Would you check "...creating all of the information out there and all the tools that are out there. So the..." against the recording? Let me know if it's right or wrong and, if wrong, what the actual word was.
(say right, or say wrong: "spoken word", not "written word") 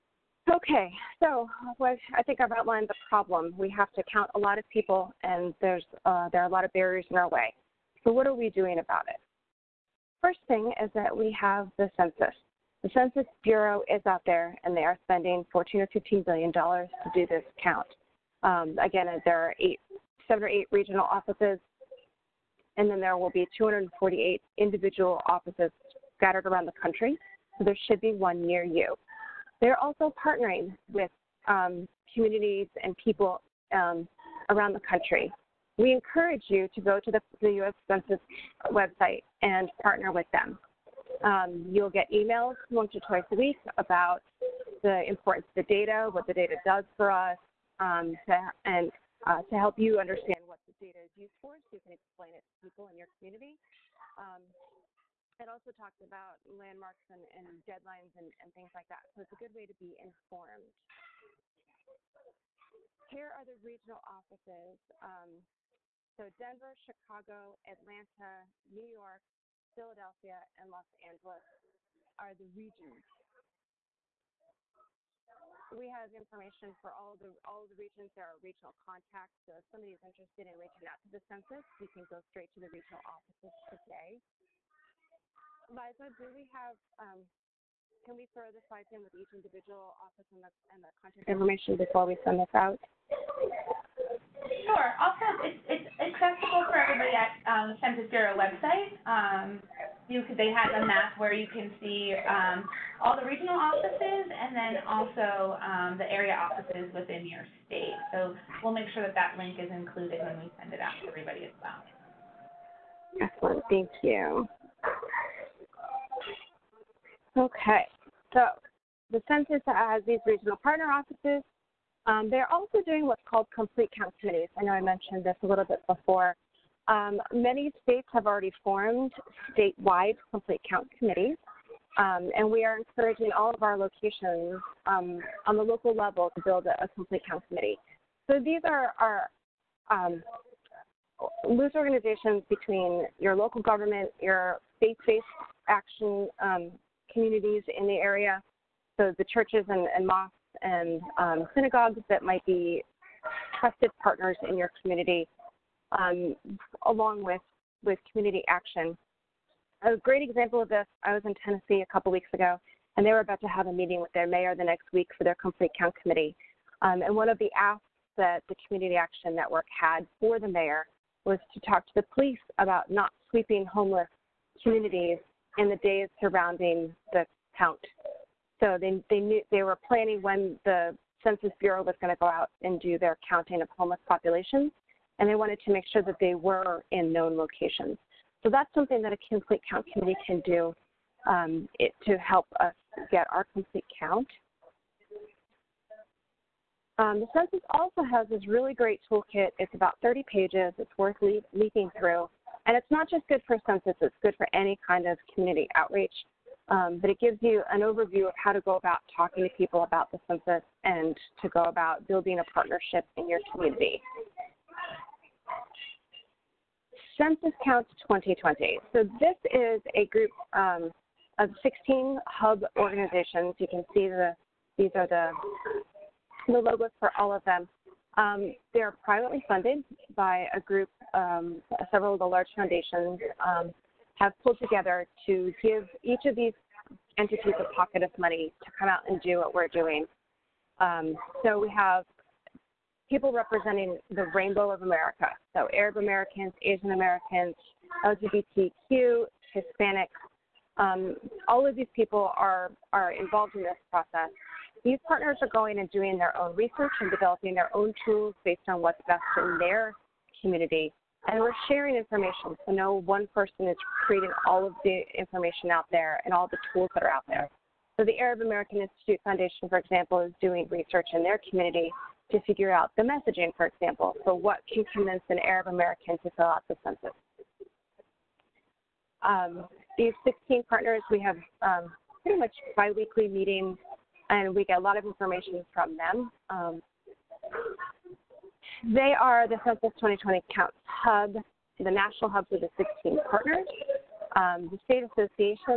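right.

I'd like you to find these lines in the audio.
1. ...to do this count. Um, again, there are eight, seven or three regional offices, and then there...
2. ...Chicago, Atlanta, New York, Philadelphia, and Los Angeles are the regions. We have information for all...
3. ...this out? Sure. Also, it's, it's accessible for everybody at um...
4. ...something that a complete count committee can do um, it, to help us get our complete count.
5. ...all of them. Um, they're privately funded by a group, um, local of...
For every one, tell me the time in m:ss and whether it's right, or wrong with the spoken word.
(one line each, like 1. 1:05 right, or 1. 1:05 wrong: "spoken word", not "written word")
1. 0:17 wrong: "eight", not "three"
2. 1:06 right
3. 1:32 right
4. 3:08 right
5. 3:47 wrong: "several", not "local".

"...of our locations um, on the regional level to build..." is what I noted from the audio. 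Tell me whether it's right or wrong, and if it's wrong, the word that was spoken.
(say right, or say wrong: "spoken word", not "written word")
wrong: "local", not "regional".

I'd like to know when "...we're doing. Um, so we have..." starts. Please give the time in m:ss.
3:59.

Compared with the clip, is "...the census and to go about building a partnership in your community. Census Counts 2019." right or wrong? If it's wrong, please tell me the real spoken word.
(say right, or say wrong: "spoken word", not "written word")
wrong: "2020", not "2019".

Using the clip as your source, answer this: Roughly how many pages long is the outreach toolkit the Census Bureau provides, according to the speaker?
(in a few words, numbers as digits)
30.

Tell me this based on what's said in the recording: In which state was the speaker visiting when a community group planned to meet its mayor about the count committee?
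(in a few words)
Tennessee.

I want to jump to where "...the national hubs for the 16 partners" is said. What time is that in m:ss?
4:51.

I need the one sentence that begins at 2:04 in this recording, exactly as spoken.
I know I mentioned this a little bit before.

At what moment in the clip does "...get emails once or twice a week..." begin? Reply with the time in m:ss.
0:41.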